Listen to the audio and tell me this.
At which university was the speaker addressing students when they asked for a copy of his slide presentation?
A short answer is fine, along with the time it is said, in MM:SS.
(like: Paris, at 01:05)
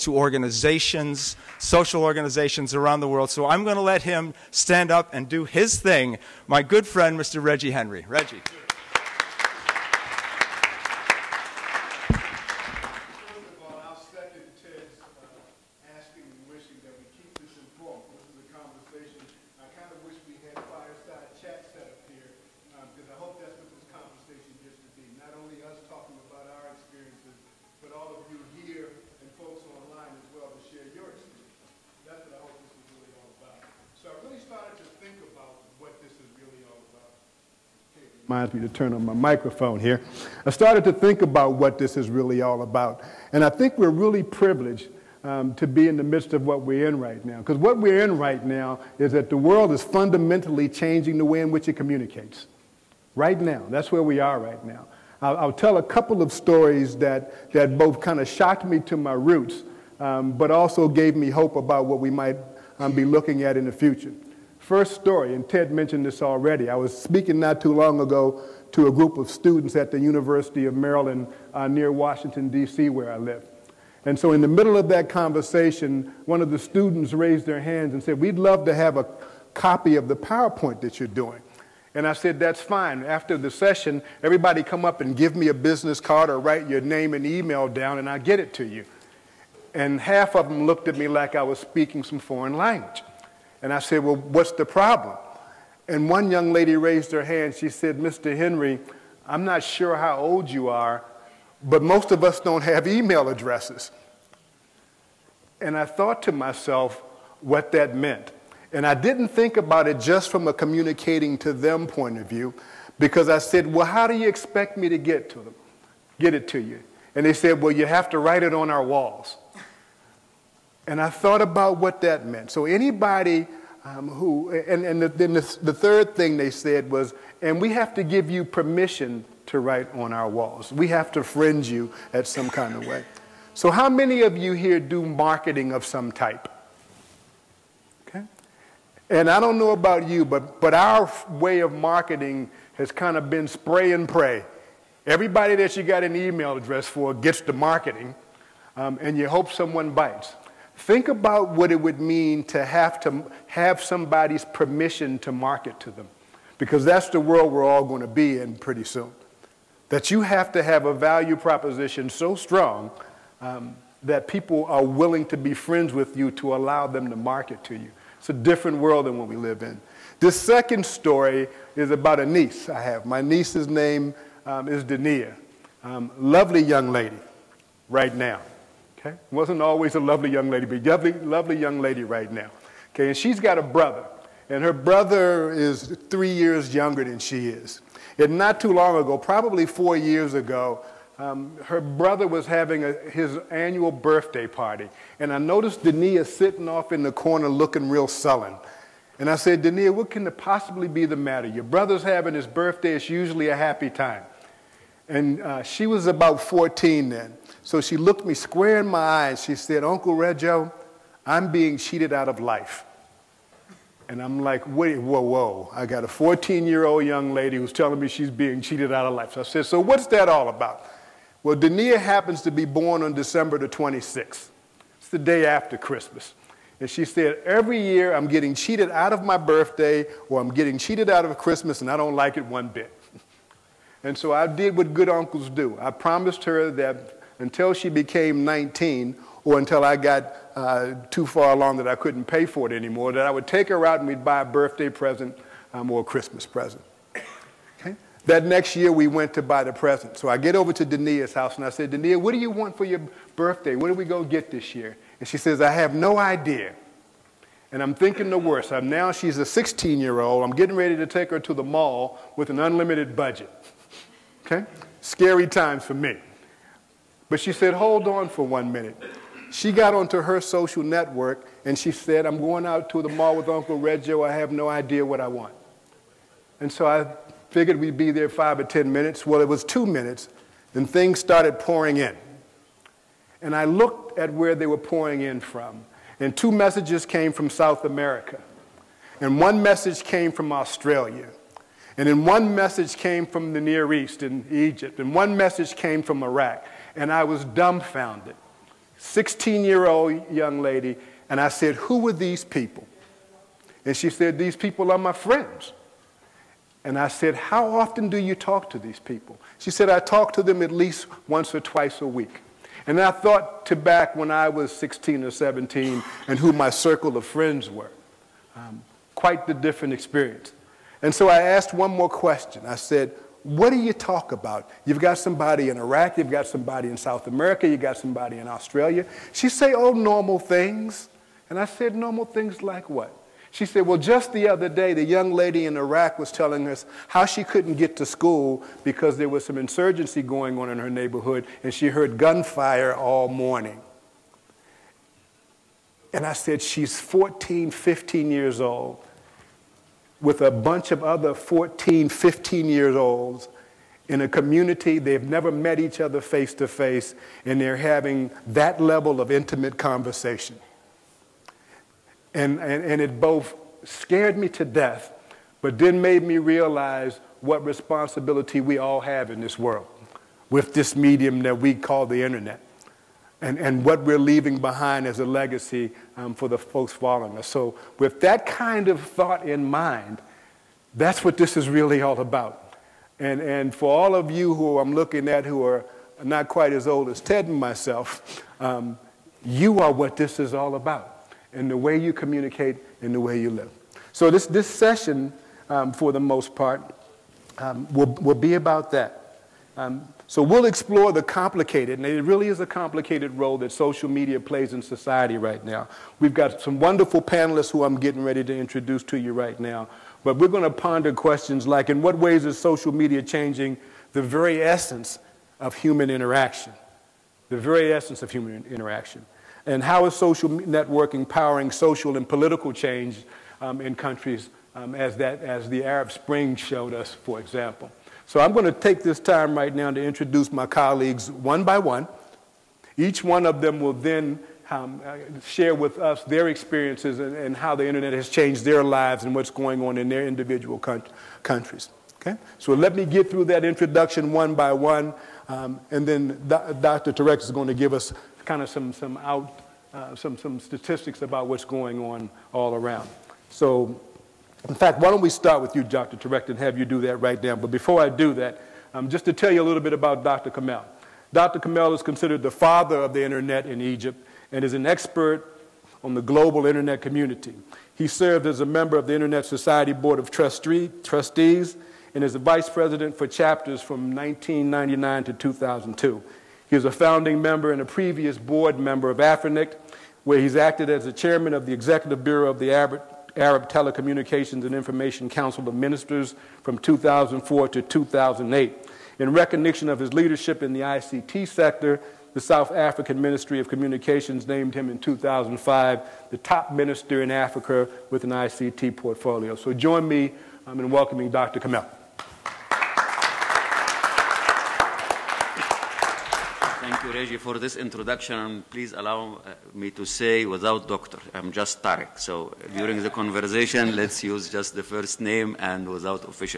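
University of Maryland, at 01:09.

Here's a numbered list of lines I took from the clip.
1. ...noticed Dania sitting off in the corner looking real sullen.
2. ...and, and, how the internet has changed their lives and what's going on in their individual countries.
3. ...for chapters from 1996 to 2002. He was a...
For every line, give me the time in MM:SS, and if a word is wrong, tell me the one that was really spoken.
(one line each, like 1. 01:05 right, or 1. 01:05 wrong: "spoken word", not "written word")
1. 03:15 right
2. 07:17 right
3. 07:53 wrong: "1999", not "1996".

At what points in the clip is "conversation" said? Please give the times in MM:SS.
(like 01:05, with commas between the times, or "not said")
01:15, 05:59, 08:33.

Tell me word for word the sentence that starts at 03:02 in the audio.
Okay, and she's got a brother, and her brother is three years younger than she is.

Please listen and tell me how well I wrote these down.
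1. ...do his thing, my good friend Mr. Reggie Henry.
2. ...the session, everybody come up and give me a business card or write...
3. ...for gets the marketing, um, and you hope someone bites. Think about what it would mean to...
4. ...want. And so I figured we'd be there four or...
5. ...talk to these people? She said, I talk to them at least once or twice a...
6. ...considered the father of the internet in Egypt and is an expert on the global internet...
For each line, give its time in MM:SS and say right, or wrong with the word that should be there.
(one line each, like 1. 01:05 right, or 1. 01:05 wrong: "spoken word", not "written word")
1. 00:05 right
2. 01:23 right
3. 02:26 right
4. 04:35 wrong: "five", not "four"
5. 05:08 right
6. 07:42 right.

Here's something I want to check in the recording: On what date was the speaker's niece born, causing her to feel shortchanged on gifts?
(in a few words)
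December 26.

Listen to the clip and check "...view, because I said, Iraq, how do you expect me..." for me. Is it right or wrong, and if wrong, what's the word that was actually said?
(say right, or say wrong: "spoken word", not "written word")
wrong: "Well", not "Iraq".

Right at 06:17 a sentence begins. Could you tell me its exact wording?
So with that kind of thought in mind, that's what this is really all about.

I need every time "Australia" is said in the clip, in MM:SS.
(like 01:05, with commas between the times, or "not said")
04:50, 05:28.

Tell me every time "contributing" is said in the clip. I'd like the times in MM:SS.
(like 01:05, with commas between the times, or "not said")
not said.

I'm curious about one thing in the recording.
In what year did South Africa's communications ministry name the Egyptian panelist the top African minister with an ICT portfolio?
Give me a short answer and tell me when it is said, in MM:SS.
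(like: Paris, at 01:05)
2005, at 08:14.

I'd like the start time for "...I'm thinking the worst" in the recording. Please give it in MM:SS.
04:17.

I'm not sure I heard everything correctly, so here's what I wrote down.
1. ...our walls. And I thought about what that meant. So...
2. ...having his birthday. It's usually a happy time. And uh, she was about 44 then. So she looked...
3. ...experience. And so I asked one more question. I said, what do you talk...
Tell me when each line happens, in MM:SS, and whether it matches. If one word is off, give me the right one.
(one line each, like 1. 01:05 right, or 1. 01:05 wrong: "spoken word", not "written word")
1. 01:58 right
2. 03:22 wrong: "14", not "44"
3. 05:19 right.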